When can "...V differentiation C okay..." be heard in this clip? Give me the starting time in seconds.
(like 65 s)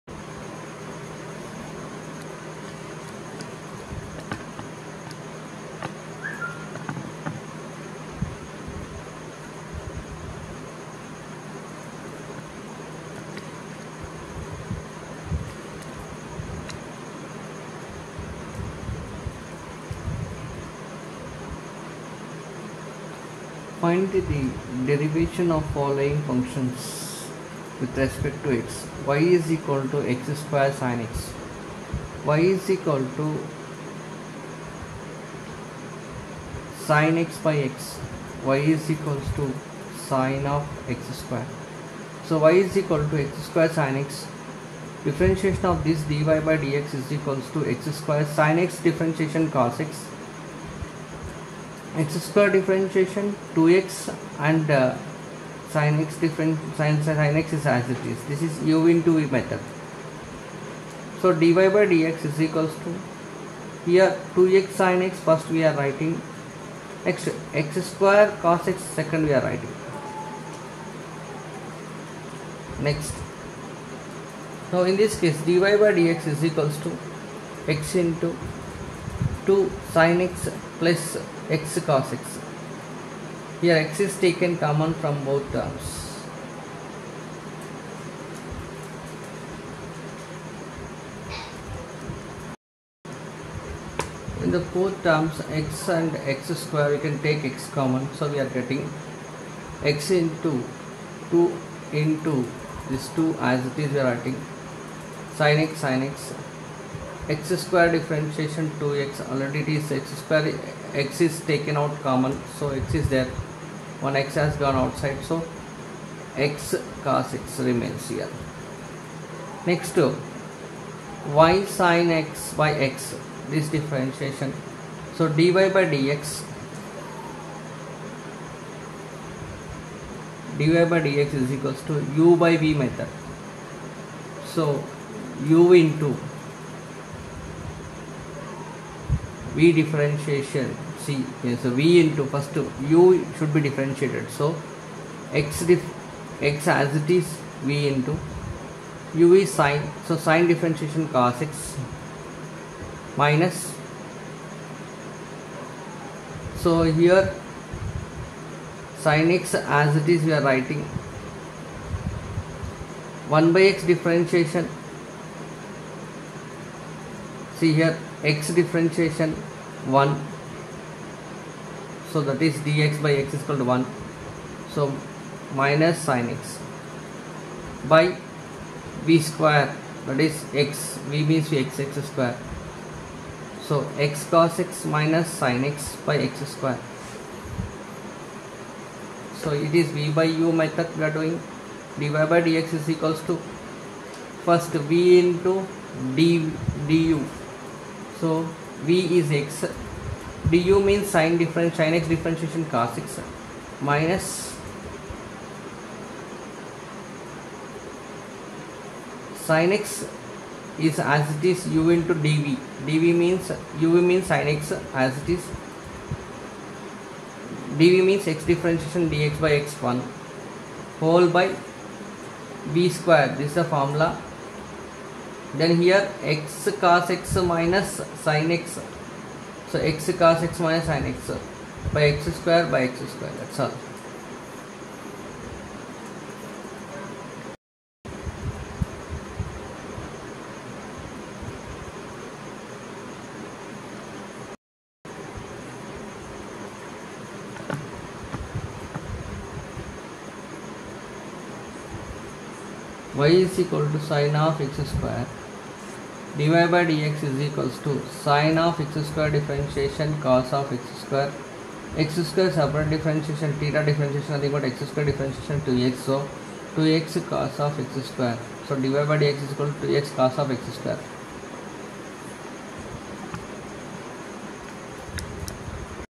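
139 s.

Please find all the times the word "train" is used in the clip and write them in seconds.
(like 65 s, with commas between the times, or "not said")
not said.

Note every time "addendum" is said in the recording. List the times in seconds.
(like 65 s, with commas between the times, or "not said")
not said.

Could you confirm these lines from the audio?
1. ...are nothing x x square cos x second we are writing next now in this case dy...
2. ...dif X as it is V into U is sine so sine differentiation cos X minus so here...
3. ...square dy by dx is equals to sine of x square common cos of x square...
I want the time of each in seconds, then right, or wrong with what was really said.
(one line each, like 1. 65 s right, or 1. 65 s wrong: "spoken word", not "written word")
1. 65 s wrong: "writing", not "nothing"
2. 145 s right
3. 254 s wrong: "differentiation", not "common".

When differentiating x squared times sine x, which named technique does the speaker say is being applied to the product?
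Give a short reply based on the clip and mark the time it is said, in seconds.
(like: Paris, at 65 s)
u into v method, at 58 s.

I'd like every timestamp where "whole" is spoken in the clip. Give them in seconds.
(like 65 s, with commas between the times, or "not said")
220 s.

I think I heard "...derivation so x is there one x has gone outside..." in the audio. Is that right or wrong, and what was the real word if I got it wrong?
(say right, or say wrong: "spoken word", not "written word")
wrong: "common", not "derivation".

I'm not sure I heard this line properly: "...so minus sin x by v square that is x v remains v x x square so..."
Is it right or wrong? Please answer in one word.
wrong.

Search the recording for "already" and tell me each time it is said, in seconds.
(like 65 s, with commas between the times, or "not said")
109 s.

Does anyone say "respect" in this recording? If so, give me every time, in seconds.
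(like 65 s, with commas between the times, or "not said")
28 s.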